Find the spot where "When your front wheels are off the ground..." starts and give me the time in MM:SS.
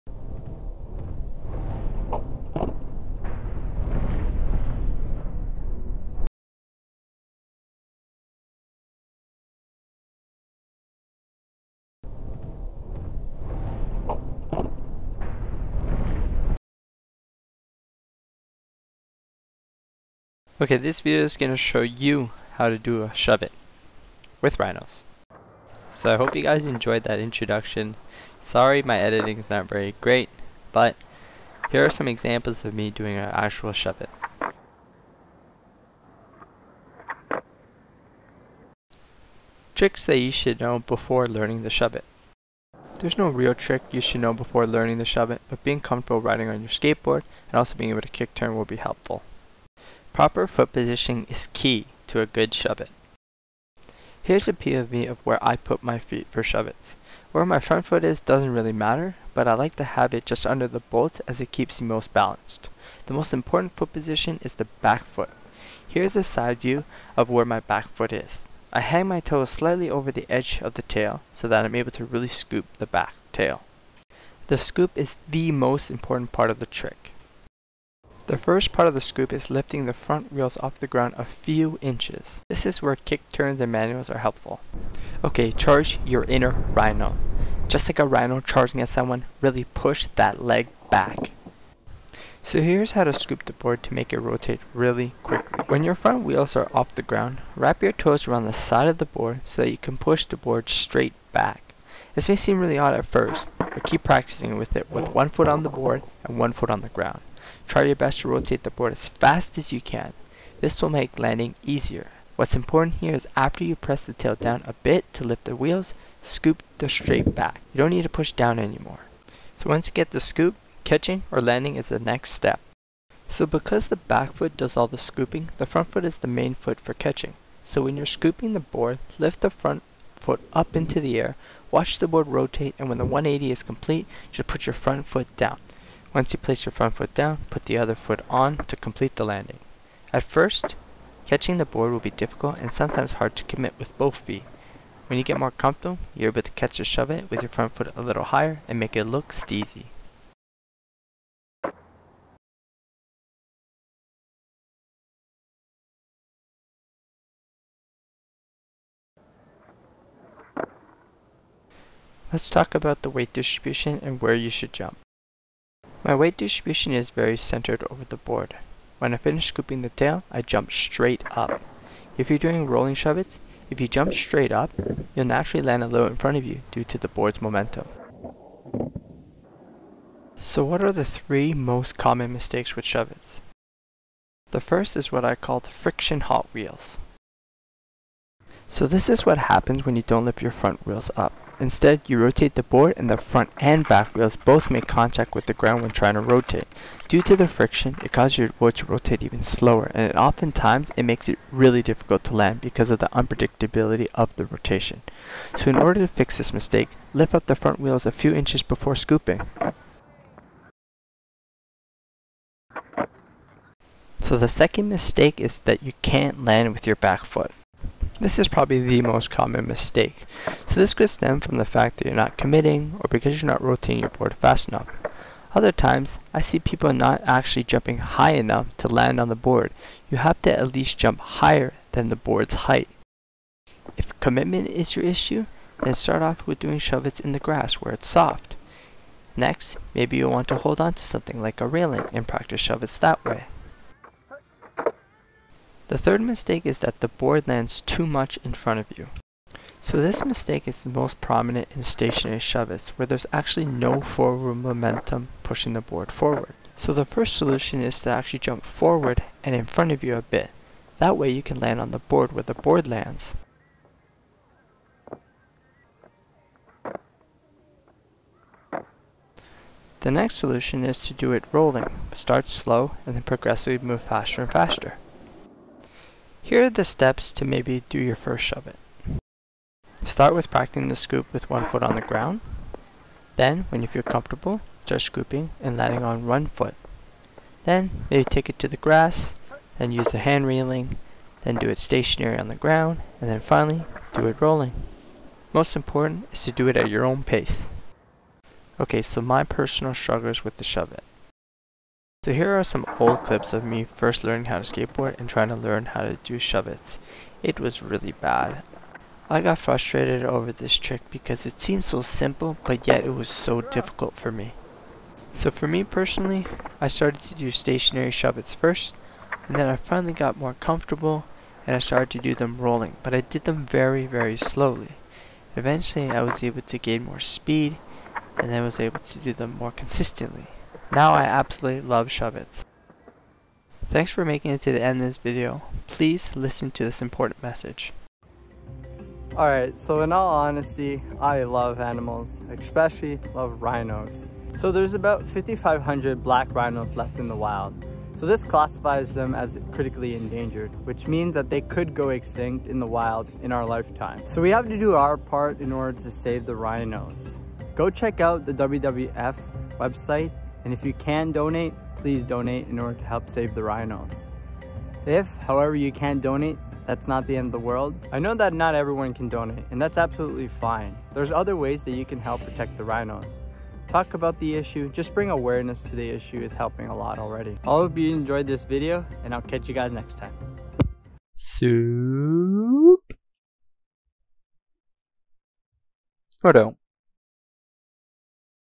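01:35.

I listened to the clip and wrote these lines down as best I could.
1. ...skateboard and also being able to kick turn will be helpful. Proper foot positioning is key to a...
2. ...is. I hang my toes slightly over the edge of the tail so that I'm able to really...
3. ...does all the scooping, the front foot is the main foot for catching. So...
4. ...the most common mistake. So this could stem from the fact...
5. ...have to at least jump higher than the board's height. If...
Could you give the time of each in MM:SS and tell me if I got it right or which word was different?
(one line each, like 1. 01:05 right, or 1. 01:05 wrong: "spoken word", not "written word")
1. 00:46 right
2. 01:08 right
3. 02:04 right
4. 03:38 right
5. 03:50 right.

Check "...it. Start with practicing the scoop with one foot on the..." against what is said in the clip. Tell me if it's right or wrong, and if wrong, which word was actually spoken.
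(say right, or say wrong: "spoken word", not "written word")
right.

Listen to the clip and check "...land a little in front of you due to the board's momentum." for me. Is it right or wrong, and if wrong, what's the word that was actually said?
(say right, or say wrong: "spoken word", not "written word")
right.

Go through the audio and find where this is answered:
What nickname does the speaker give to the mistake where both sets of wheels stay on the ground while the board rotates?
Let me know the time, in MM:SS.
03:05.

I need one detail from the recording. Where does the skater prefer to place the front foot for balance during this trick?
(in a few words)
Just under the bolt.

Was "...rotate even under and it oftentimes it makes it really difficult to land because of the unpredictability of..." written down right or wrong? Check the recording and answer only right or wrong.
wrong.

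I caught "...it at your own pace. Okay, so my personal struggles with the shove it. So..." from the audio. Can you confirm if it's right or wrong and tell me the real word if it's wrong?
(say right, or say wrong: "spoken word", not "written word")
right.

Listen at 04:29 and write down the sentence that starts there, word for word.
The next solution is to do it rolling.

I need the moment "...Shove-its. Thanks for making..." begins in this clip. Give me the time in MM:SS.
05:32.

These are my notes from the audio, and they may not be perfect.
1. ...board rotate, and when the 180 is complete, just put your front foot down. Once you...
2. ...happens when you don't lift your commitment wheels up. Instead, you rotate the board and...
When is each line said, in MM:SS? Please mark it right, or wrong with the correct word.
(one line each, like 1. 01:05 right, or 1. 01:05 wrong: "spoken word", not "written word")
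1. 02:12 right
2. 03:09 wrong: "front", not "commitment".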